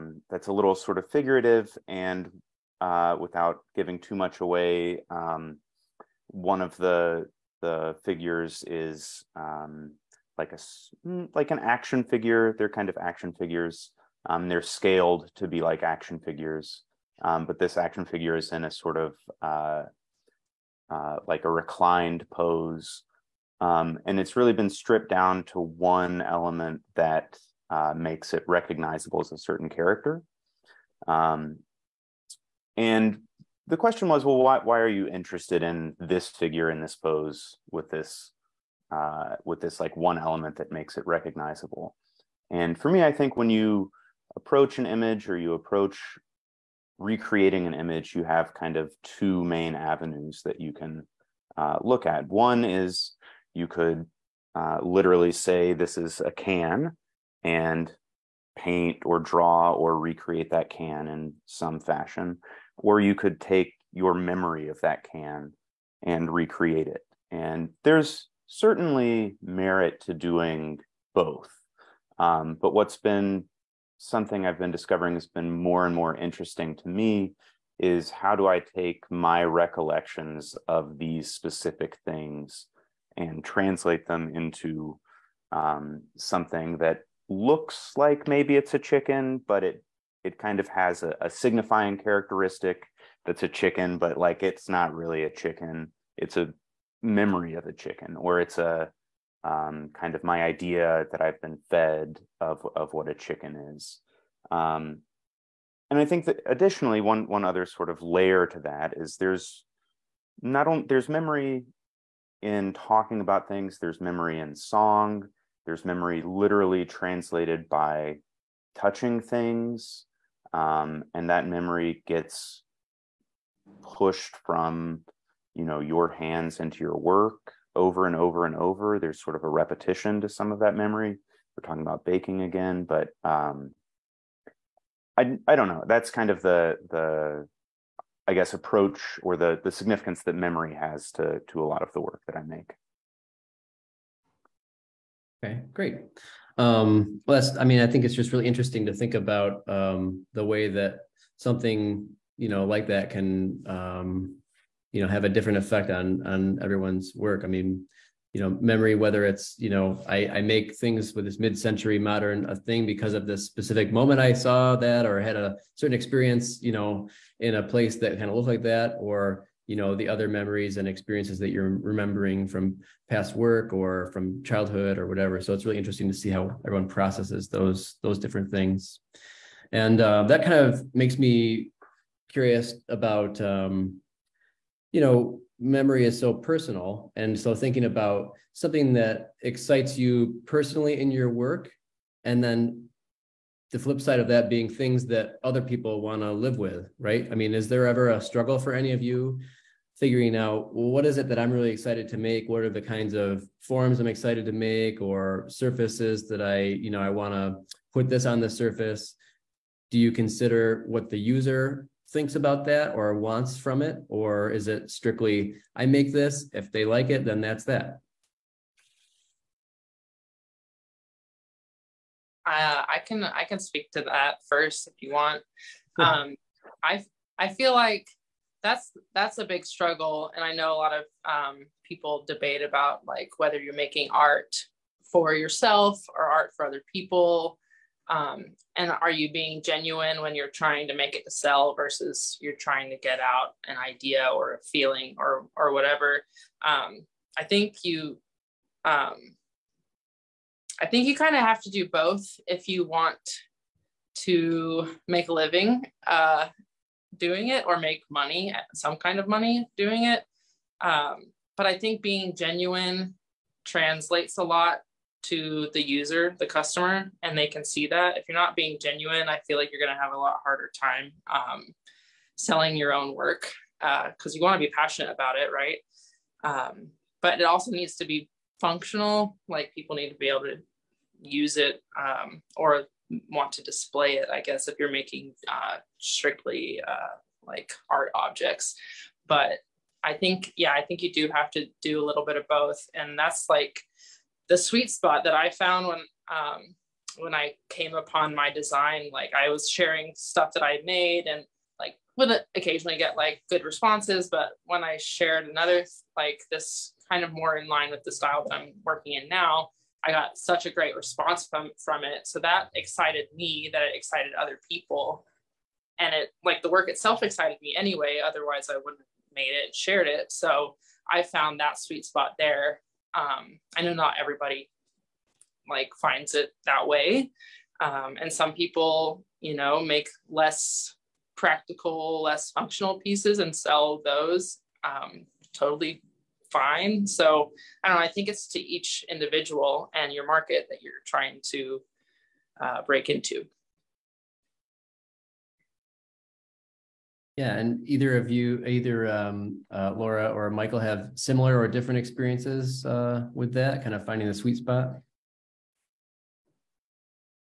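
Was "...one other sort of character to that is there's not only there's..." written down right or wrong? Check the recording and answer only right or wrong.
wrong.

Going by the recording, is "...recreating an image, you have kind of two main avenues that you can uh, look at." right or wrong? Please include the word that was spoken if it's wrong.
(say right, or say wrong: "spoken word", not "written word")
right.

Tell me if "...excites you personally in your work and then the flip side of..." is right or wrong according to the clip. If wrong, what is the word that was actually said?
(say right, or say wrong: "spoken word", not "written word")
right.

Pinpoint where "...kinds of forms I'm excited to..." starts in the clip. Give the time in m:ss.
3:22.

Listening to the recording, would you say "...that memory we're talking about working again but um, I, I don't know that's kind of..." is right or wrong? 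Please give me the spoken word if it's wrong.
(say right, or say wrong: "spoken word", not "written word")
wrong: "baking", not "working".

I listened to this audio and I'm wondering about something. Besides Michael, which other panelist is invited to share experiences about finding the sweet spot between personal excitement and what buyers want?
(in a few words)
Laura.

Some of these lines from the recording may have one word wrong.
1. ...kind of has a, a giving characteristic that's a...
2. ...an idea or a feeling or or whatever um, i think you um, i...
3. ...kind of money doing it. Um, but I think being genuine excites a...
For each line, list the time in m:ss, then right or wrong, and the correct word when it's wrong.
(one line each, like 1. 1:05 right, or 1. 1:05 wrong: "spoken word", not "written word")
1. 1:30 wrong: "signifying", not "giving"
2. 4:03 right
3. 4:18 wrong: "translates", not "excites".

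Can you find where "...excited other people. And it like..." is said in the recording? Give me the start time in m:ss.
5:13.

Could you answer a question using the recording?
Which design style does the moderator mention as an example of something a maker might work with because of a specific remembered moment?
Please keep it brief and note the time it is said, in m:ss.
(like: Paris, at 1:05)
mid-century modern, at 2:41.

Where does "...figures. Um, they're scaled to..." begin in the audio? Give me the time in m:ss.
0:13.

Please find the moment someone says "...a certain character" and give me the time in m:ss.
0:29.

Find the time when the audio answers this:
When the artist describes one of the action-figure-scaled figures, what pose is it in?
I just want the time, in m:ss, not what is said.
0:21.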